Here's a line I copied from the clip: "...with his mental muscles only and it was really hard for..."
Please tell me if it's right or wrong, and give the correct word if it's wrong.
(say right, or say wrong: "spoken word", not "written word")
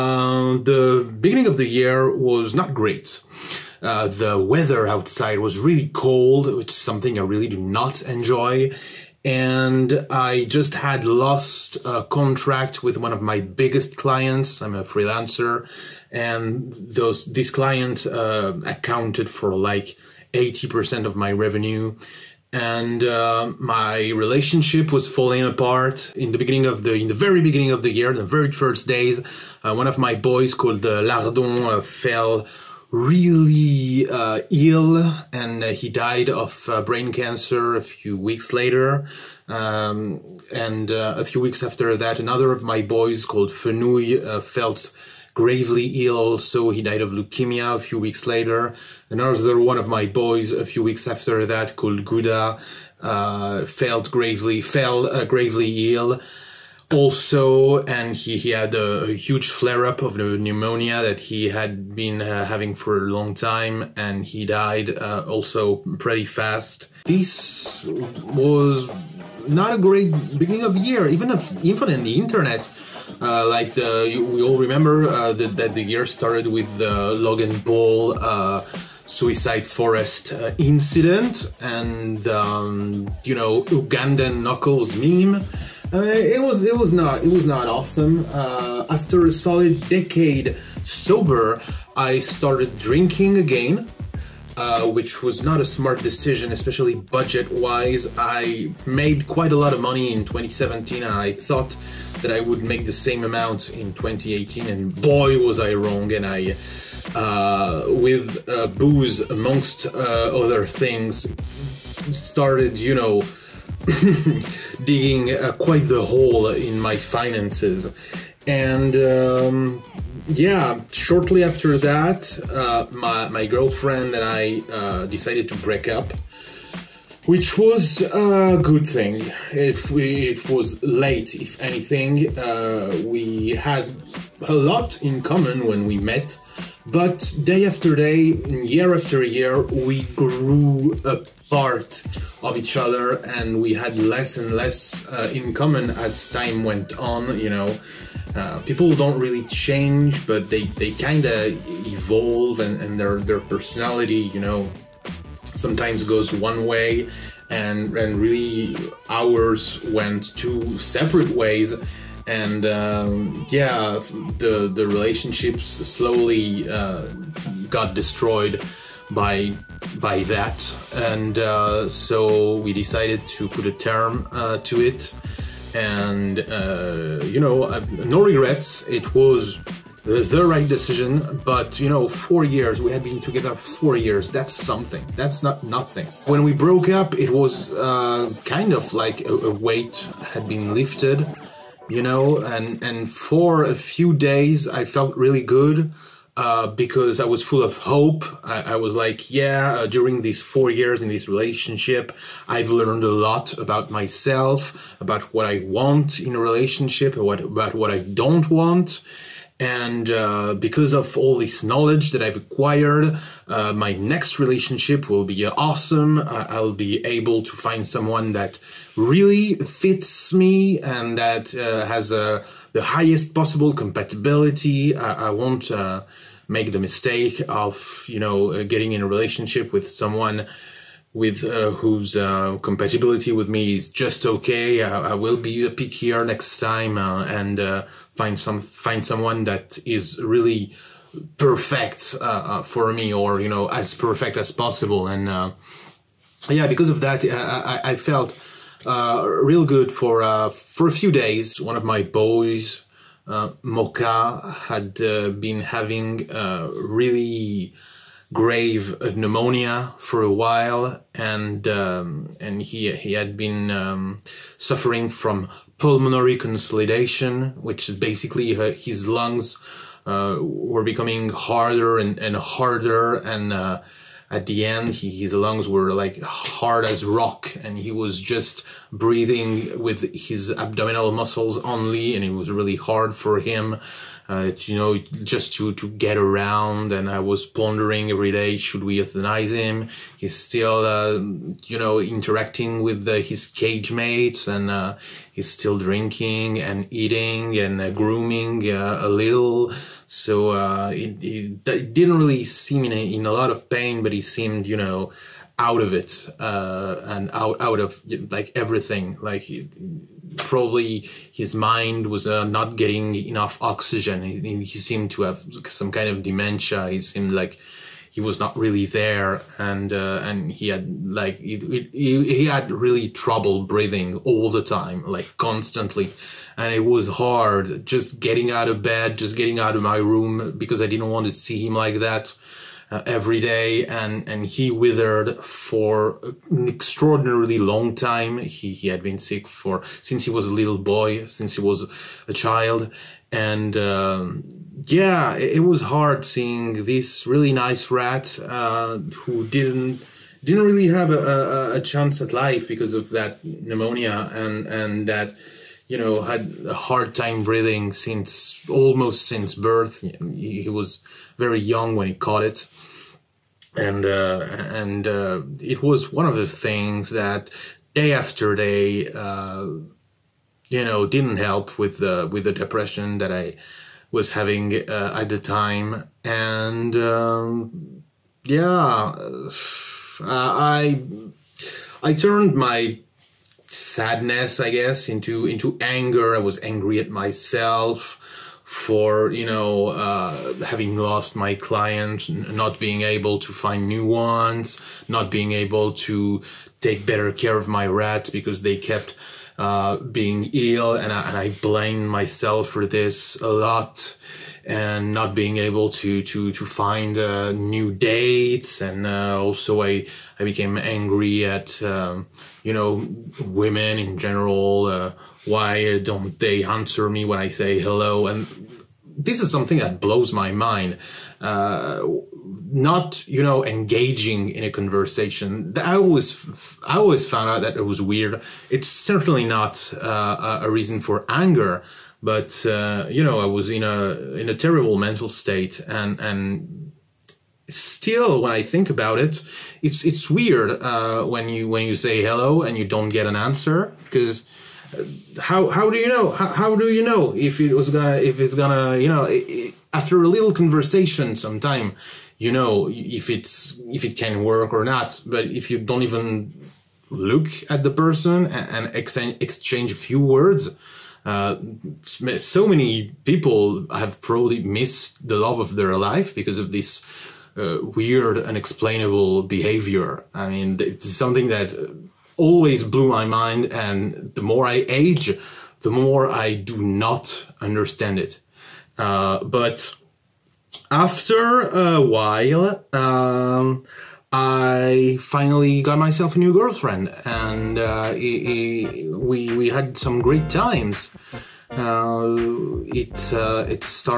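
wrong: "abdominal", not "mental".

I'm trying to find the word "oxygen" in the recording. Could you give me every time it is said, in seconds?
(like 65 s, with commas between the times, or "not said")
313 s.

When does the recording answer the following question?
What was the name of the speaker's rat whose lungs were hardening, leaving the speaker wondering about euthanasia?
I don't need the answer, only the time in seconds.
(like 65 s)
253 s.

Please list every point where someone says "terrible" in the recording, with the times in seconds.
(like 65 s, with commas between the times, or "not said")
434 s.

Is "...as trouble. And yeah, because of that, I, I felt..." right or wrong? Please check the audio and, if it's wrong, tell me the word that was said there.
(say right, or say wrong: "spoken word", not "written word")
wrong: "possible", not "trouble".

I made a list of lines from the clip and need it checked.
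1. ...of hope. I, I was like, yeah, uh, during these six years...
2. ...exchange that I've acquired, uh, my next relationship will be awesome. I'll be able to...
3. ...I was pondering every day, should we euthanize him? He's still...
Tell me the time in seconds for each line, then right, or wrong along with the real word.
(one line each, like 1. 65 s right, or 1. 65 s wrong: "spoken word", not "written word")
1. 197 s wrong: "four", not "six"
2. 211 s wrong: "knowledge", not "exchange"
3. 287 s right.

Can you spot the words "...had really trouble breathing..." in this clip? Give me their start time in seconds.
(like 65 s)
322 s.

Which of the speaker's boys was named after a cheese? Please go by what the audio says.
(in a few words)
Gouda.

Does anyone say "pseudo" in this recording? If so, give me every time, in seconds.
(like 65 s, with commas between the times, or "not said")
not said.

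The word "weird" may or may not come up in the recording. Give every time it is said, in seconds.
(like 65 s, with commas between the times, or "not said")
428 s, 440 s, 467 s.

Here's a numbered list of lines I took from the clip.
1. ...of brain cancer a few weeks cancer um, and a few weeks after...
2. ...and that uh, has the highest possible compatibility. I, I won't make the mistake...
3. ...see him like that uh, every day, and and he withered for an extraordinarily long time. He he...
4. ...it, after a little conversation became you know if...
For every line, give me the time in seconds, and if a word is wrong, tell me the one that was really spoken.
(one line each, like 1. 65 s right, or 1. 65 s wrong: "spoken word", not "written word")
1. 36 s wrong: "later", not "cancer"
2. 220 s right
3. 331 s right
4. 449 s wrong: "sometime", not "became".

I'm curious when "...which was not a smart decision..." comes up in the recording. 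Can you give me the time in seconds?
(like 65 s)
94 s.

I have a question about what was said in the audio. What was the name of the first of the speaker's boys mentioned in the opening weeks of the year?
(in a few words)
Lardon.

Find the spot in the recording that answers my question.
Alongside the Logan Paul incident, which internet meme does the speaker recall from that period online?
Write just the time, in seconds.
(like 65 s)
83 s.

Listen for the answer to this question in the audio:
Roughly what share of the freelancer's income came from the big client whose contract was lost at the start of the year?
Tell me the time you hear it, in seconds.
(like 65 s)
20 s.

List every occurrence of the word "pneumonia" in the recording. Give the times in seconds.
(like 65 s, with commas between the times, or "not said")
60 s, 259 s, 353 s.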